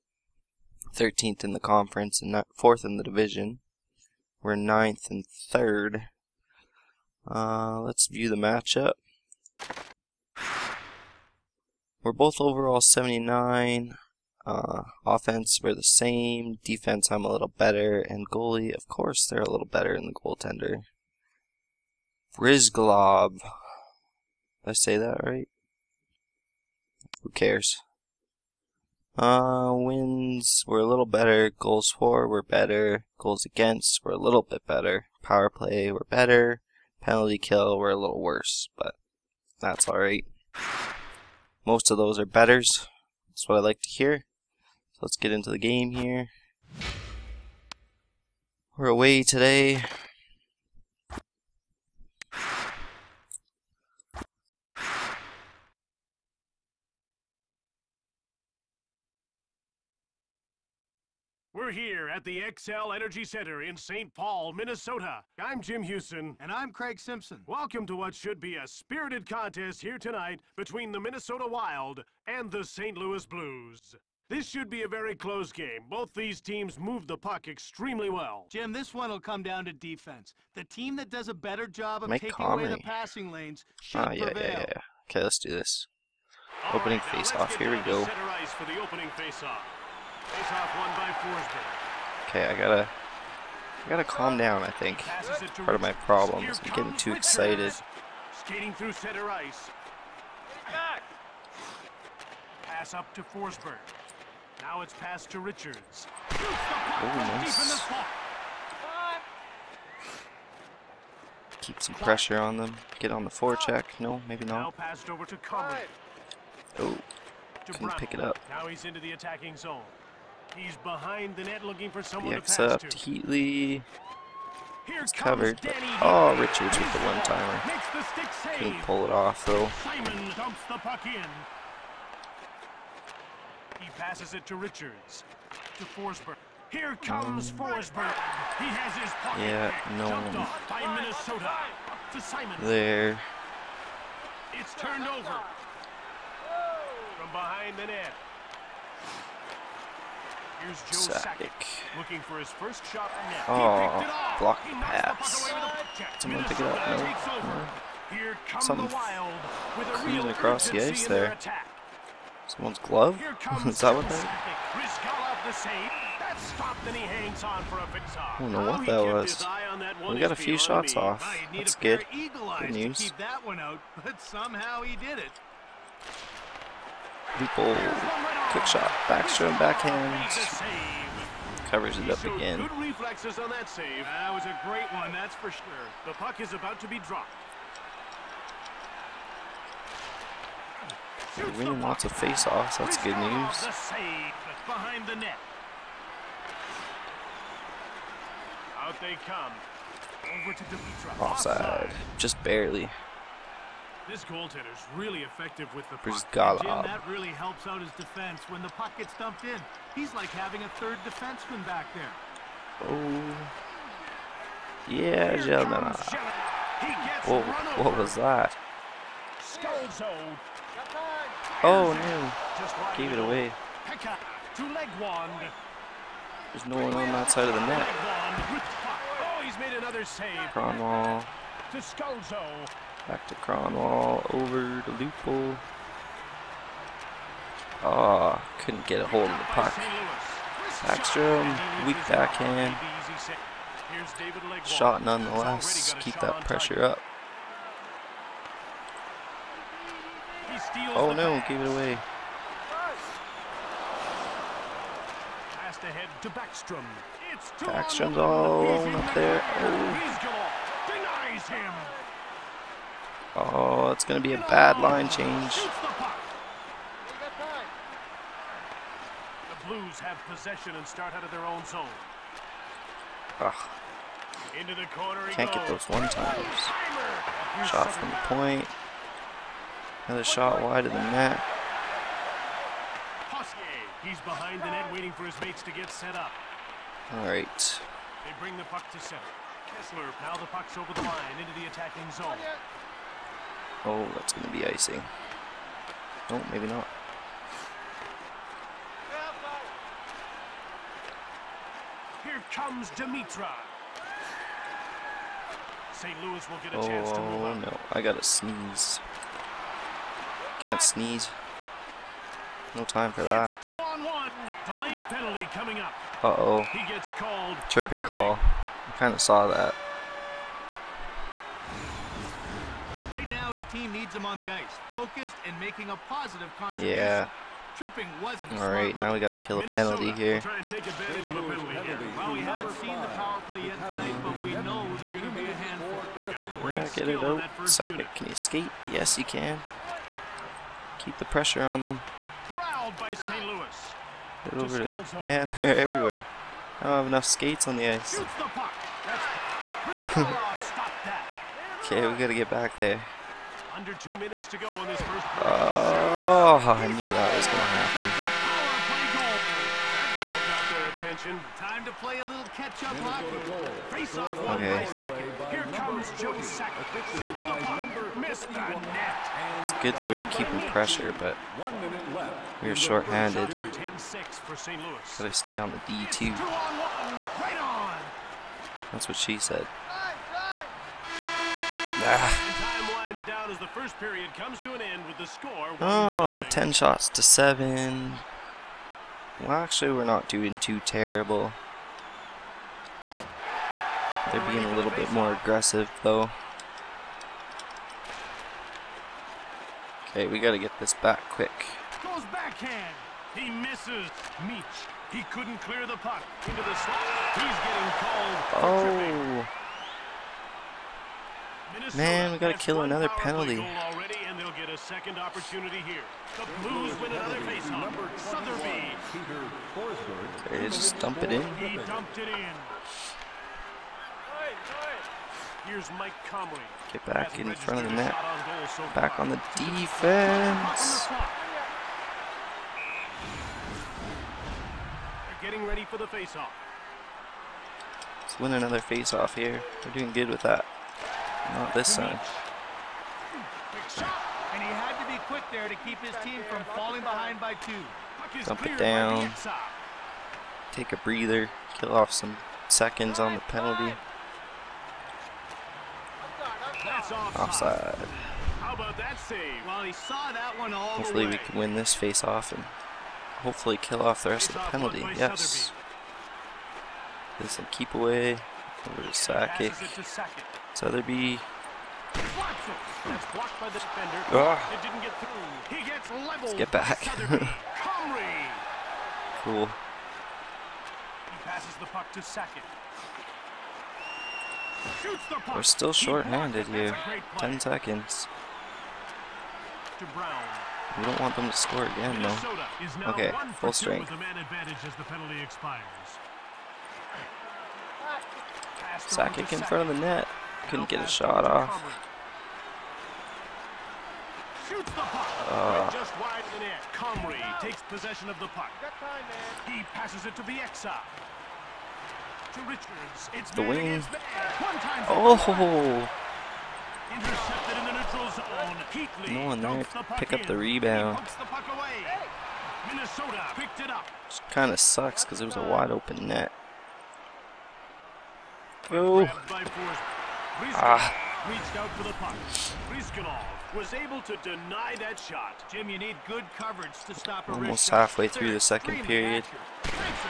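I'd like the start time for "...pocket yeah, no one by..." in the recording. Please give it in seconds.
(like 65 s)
139 s.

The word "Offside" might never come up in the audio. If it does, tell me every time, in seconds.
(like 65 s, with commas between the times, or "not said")
201 s, 457 s.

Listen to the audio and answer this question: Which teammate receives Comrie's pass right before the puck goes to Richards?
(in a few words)
Bieksa.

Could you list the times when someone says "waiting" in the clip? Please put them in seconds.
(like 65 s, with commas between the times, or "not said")
284 s.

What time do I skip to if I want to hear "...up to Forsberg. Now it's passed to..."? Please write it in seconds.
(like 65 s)
102 s.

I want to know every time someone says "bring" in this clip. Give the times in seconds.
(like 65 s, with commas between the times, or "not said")
288 s.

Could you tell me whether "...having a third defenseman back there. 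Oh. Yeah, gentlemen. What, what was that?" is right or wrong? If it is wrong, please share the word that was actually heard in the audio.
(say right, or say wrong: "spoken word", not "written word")
right.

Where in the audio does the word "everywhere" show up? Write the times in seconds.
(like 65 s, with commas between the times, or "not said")
345 s.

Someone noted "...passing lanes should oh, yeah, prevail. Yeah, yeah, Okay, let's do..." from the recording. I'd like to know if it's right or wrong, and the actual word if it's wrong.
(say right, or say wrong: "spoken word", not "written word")
right.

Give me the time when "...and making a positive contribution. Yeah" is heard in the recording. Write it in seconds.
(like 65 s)
325 s.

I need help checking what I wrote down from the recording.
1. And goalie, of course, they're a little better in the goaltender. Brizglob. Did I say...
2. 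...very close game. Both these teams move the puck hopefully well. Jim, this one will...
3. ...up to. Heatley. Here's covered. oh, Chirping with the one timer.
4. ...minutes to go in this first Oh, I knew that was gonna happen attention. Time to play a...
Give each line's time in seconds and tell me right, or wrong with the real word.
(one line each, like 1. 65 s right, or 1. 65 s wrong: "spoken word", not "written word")
1. 17 s right
2. 74 s wrong: "extremely", not "hopefully"
3. 122 s wrong: "Richards", not "Chirping"
4. 354 s right.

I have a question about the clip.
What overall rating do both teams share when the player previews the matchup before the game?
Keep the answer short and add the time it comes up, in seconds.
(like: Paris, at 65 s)
79, at 12 s.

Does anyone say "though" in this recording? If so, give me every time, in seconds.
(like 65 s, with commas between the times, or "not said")
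129 s, 396 s, 492 s.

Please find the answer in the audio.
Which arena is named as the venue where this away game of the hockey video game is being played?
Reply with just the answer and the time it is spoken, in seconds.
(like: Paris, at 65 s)
Xcel Energy Center, at 62 s.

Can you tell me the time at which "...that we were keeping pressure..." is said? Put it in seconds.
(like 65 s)
369 s.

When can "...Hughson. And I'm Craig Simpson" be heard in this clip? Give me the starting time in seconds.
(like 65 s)
65 s.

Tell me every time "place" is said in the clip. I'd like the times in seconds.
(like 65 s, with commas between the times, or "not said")
not said.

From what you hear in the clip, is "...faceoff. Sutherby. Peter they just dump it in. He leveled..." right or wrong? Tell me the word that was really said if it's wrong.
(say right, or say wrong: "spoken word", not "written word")
wrong: "dumped", not "leveled".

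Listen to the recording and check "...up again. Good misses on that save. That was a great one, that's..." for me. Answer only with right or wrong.
wrong.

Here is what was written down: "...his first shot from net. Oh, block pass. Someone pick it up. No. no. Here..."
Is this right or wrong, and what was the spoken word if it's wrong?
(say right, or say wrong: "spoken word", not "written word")
right.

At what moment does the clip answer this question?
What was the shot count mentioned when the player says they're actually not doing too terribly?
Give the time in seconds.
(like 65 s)
386 s.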